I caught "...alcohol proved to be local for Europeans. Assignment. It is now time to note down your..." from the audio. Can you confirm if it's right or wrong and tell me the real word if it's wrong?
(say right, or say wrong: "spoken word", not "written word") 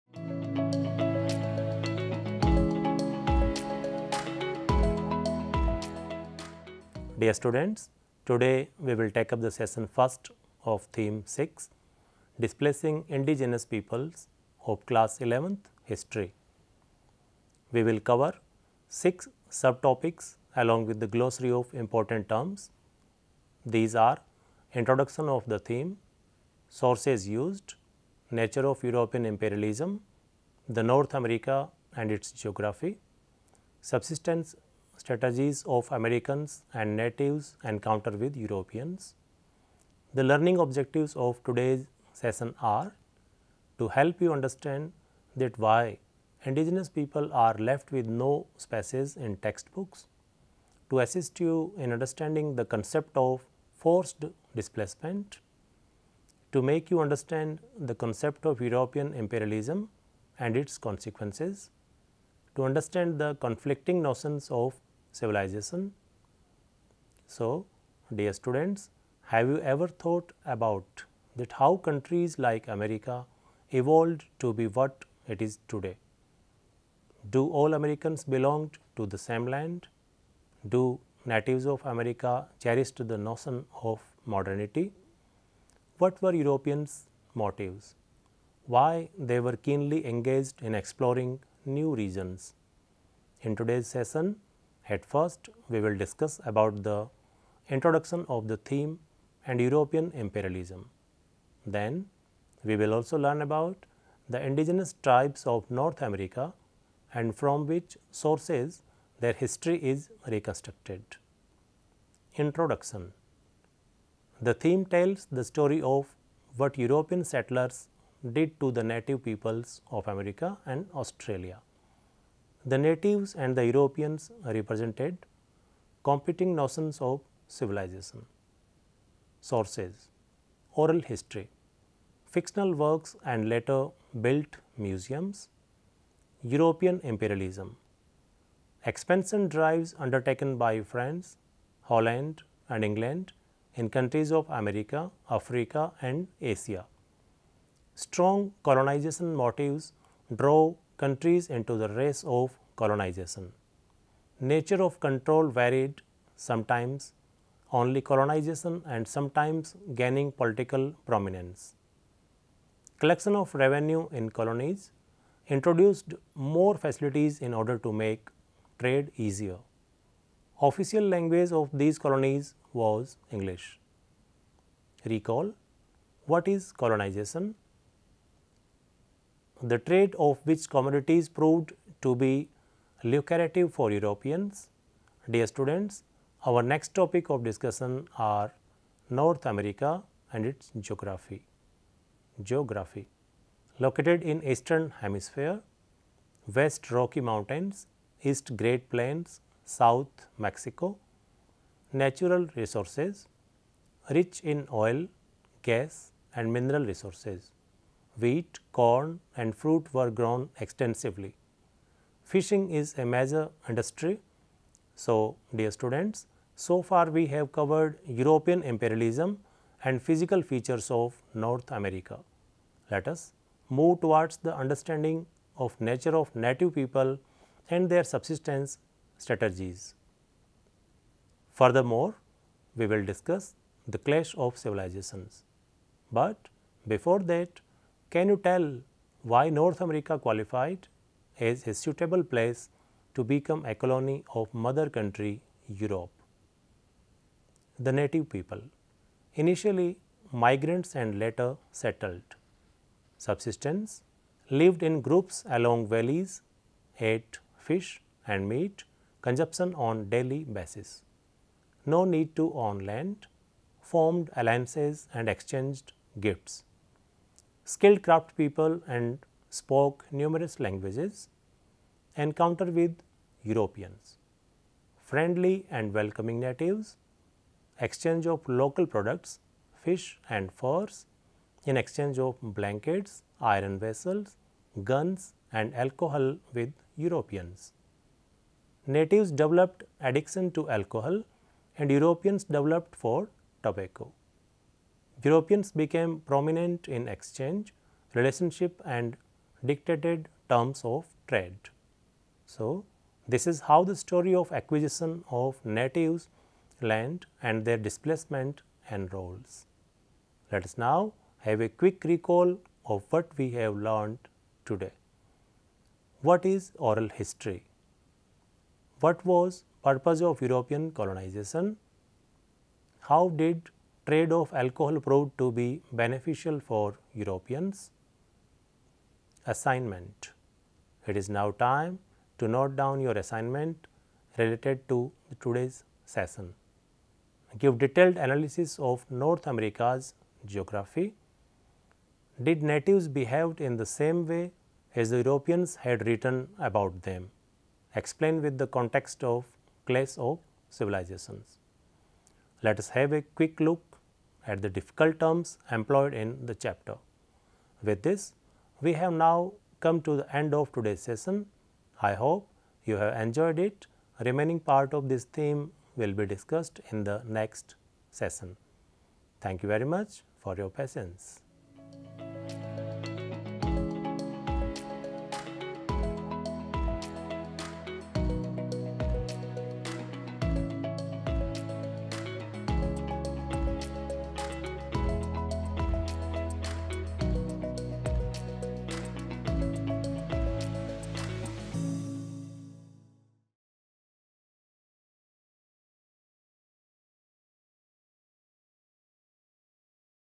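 wrong: "beneficial", not "local".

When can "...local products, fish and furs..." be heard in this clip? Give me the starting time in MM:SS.
04:38.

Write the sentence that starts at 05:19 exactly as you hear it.
What was purpose of European colonization?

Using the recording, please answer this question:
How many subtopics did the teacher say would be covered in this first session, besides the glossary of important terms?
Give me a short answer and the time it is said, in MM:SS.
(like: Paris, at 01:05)
6, at 00:18.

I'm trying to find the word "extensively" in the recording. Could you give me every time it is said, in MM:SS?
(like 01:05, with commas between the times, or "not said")
03:30.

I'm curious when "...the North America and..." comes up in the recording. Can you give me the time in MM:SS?
00:30.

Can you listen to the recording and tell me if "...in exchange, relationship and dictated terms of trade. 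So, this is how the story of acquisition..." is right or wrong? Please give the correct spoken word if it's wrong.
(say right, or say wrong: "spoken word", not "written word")
right.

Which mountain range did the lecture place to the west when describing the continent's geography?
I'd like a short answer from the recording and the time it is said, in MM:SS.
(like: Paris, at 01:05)
Rocky Mountains, at 03:16.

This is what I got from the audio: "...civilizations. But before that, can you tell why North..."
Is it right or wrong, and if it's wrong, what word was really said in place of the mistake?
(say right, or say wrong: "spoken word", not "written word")
right.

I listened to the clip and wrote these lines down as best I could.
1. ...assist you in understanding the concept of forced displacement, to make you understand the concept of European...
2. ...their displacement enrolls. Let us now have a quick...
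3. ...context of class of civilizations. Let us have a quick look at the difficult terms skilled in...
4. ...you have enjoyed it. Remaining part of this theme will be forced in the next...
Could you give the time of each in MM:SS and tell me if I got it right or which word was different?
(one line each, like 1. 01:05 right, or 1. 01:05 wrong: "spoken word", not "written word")
1. 00:50 right
2. 05:07 right
3. 05:48 wrong: "employed", not "skilled"
4. 06:02 wrong: "discussed", not "forced".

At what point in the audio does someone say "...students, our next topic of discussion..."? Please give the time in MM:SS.
03:05.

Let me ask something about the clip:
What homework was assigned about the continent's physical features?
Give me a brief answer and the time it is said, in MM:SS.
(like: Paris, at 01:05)
Detailed analysis of North America's geography, at 05:37.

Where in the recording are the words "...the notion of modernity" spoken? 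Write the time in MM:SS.
01:23.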